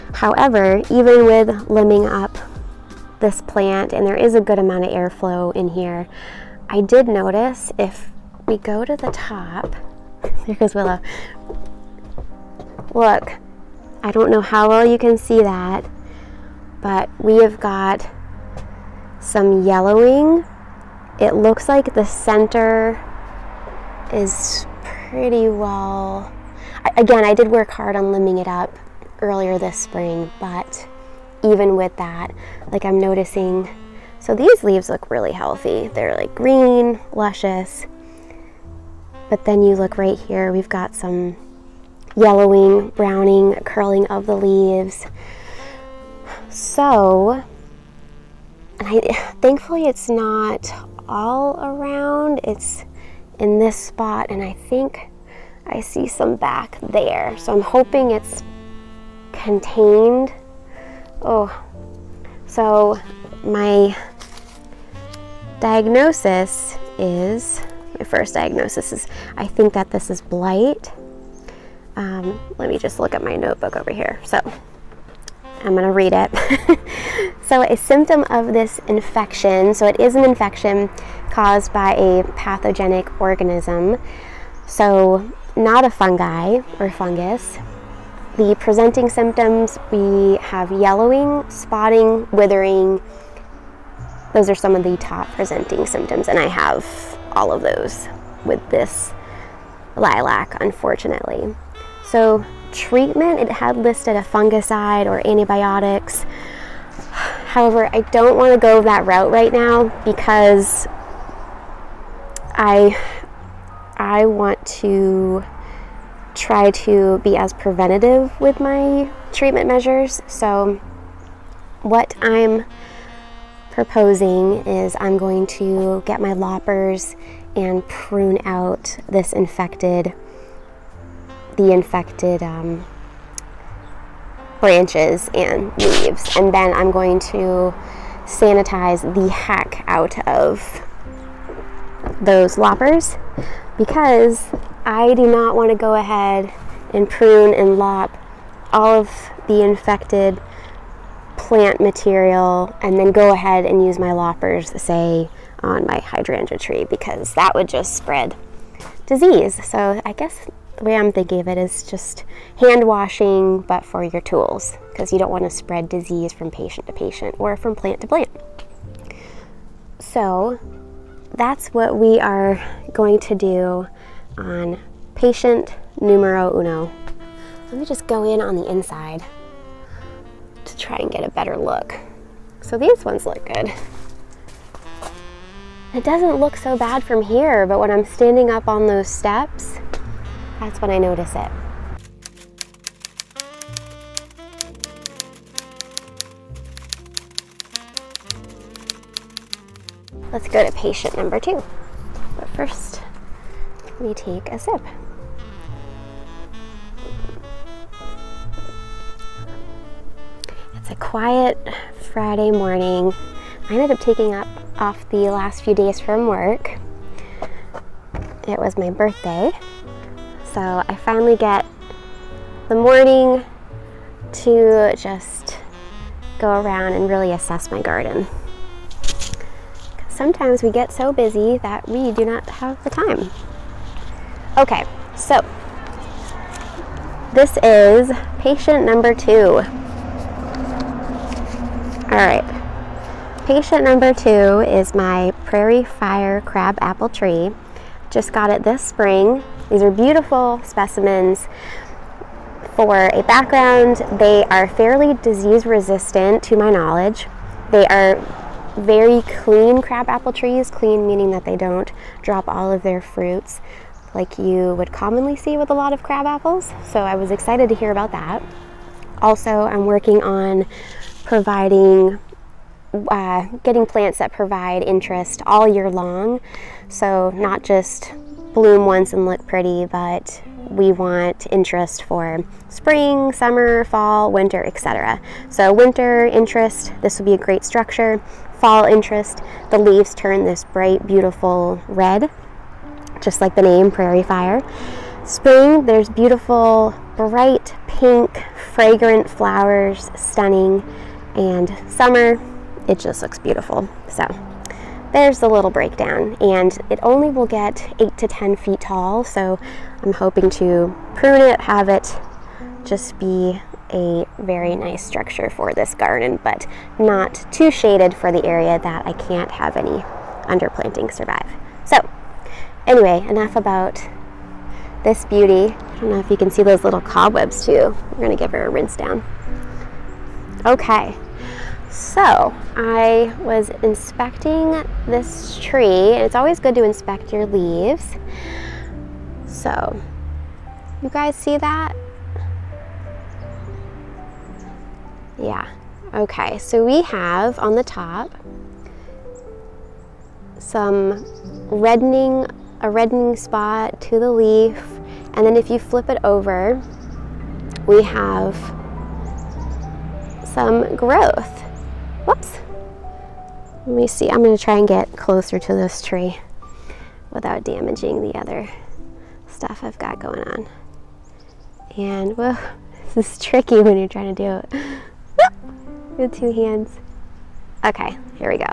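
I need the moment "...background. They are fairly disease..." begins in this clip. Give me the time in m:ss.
4:13.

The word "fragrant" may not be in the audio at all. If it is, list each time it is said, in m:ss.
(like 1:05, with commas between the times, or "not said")
4:58.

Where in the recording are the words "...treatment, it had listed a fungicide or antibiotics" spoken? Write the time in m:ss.
1:42.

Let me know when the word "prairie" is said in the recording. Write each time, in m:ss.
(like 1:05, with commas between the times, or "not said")
4:05, 4:53.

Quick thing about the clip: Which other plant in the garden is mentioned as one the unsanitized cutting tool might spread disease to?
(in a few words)
hydrangea tree.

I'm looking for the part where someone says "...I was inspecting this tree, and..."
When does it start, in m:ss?
5:32.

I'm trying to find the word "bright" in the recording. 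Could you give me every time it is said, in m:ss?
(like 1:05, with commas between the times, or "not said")
4:50, 4:57.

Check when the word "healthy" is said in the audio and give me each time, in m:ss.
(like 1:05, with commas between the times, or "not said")
0:35.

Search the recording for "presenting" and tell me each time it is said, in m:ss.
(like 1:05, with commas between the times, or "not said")
1:28, 1:35.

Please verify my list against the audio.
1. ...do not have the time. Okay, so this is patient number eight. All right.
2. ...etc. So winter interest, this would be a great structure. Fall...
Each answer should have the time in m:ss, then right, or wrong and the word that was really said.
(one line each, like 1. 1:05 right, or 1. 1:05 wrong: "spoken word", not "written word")
1. 3:52 wrong: "two", not "eight"
2. 4:44 right.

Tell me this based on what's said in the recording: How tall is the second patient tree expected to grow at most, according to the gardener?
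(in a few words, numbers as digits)
8 to 10 feet.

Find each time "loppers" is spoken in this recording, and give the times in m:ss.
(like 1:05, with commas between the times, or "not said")
2:06, 2:22, 2:34.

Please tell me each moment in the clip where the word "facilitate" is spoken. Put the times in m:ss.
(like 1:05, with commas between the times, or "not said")
not said.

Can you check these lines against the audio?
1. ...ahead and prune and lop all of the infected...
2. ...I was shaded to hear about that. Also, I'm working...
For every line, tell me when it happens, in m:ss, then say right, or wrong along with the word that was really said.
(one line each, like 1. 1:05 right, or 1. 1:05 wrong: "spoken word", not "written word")
1. 2:25 right
2. 4:27 wrong: "excited", not "shaded".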